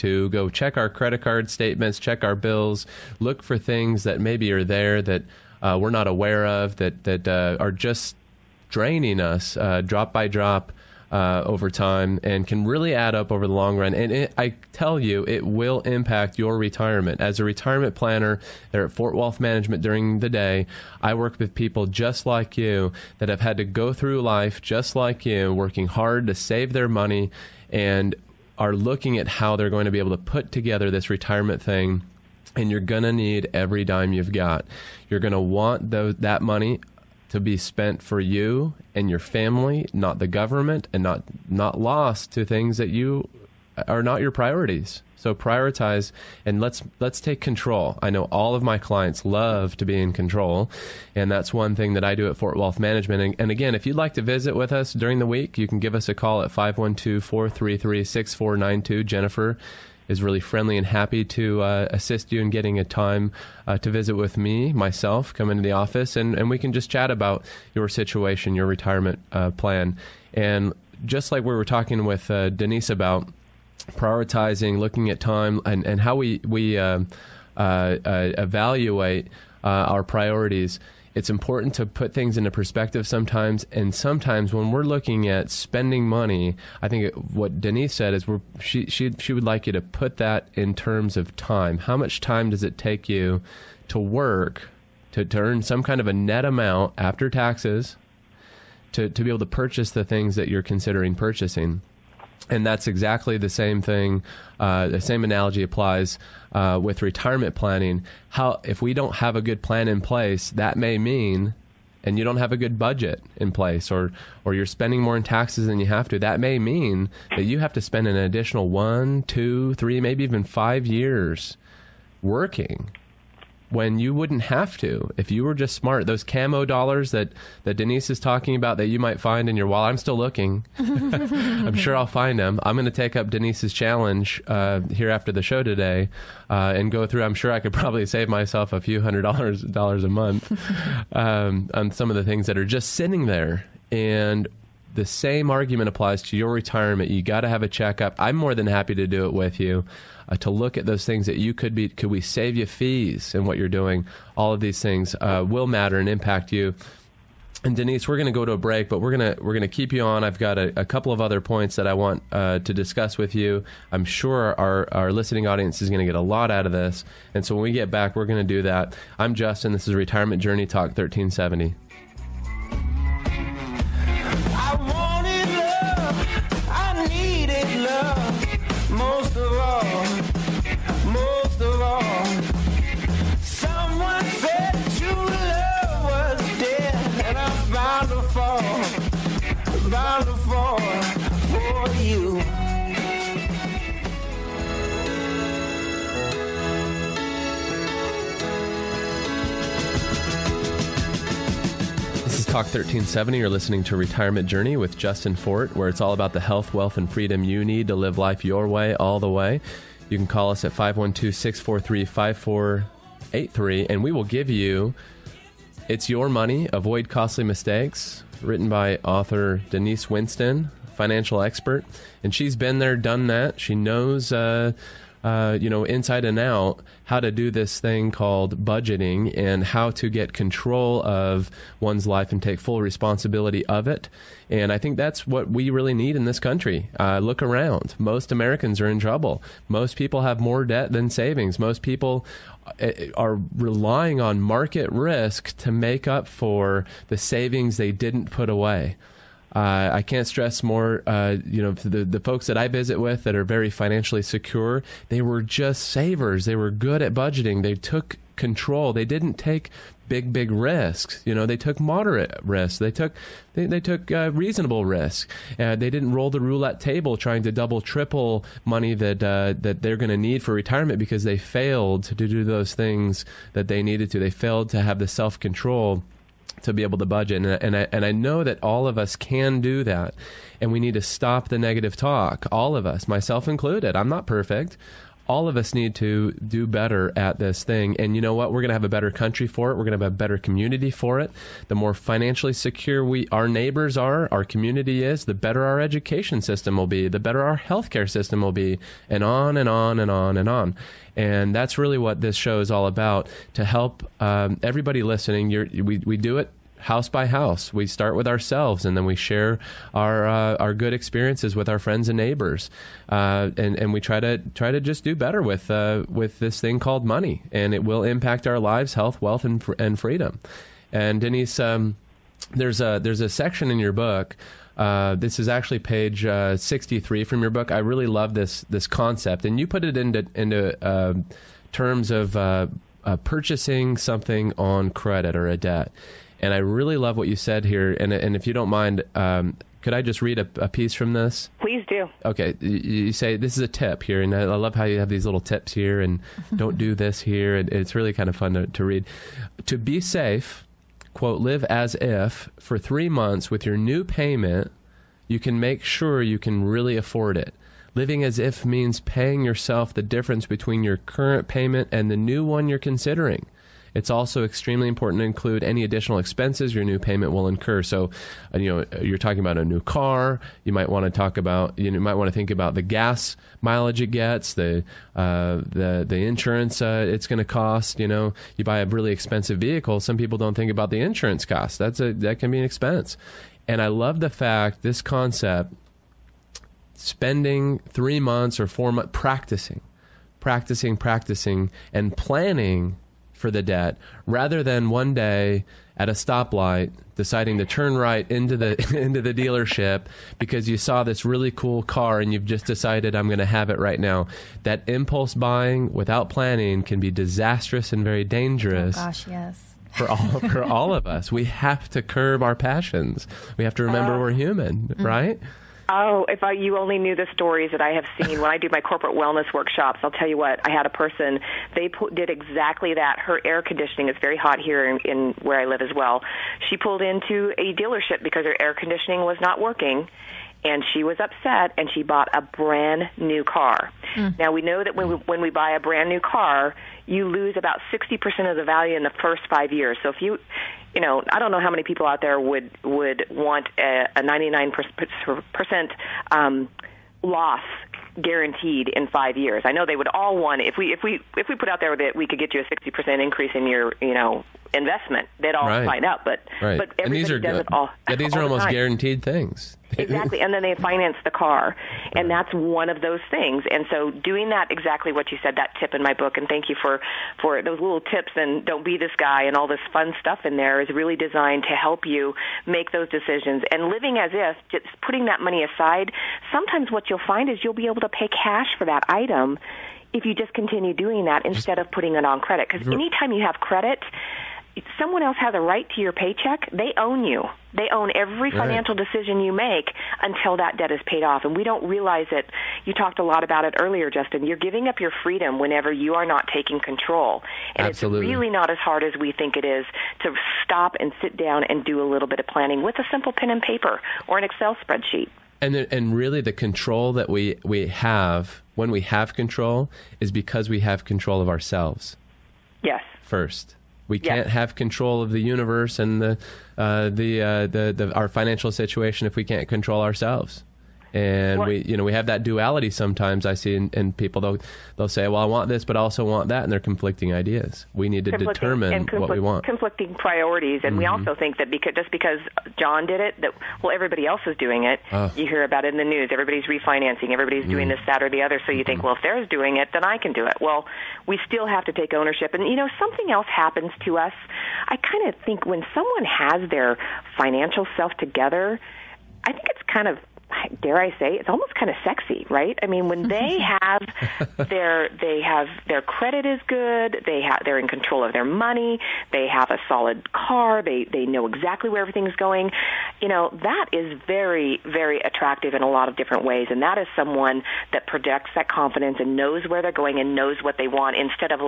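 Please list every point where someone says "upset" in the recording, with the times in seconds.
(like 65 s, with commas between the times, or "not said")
431 s.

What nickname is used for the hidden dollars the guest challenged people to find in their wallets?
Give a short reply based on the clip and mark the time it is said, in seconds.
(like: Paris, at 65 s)
camo dollars, at 126 s.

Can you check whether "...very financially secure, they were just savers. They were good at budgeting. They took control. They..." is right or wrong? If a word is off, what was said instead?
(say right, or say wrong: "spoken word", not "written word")
right.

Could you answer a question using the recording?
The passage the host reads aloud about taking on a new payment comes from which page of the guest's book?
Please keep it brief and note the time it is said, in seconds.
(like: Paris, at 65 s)
63, at 326 s.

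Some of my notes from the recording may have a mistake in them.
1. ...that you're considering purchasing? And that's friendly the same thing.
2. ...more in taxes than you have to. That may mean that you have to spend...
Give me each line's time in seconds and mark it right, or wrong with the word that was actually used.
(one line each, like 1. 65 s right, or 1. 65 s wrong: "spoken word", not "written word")
1. 100 s wrong: "exactly", not "friendly"
2. 115 s right.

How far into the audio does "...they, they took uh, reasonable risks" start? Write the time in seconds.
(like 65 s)
263 s.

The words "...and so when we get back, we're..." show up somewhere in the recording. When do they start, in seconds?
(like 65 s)
167 s.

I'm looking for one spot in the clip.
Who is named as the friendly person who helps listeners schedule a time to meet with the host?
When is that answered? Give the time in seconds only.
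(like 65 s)
59 s.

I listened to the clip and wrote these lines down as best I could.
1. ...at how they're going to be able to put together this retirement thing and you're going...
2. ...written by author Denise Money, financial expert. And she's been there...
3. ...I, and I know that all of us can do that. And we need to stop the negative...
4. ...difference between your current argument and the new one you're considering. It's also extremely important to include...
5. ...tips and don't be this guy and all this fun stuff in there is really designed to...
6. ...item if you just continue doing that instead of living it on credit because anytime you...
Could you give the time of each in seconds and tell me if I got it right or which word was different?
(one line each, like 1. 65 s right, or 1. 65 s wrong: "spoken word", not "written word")
1. 29 s right
2. 218 s wrong: "Winston", not "Money"
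3. 277 s right
4. 360 s wrong: "payment", not "argument"
5. 468 s right
6. 479 s wrong: "putting", not "living".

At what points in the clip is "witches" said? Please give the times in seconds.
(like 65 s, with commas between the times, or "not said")
not said.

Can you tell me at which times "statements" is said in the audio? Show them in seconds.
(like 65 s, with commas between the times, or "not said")
1 s.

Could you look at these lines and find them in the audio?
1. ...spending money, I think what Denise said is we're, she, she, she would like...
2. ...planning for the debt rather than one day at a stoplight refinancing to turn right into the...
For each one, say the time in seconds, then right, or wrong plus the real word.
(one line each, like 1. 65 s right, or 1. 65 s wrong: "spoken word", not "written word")
1. 85 s right
2. 392 s wrong: "deciding", not "refinancing".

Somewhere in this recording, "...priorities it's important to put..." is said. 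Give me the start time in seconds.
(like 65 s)
80 s.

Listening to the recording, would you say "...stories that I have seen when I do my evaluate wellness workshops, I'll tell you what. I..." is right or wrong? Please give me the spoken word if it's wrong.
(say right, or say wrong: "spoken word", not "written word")
wrong: "corporate", not "evaluate".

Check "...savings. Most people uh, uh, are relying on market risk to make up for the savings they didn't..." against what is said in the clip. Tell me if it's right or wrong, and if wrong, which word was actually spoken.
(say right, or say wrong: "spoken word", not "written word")
right.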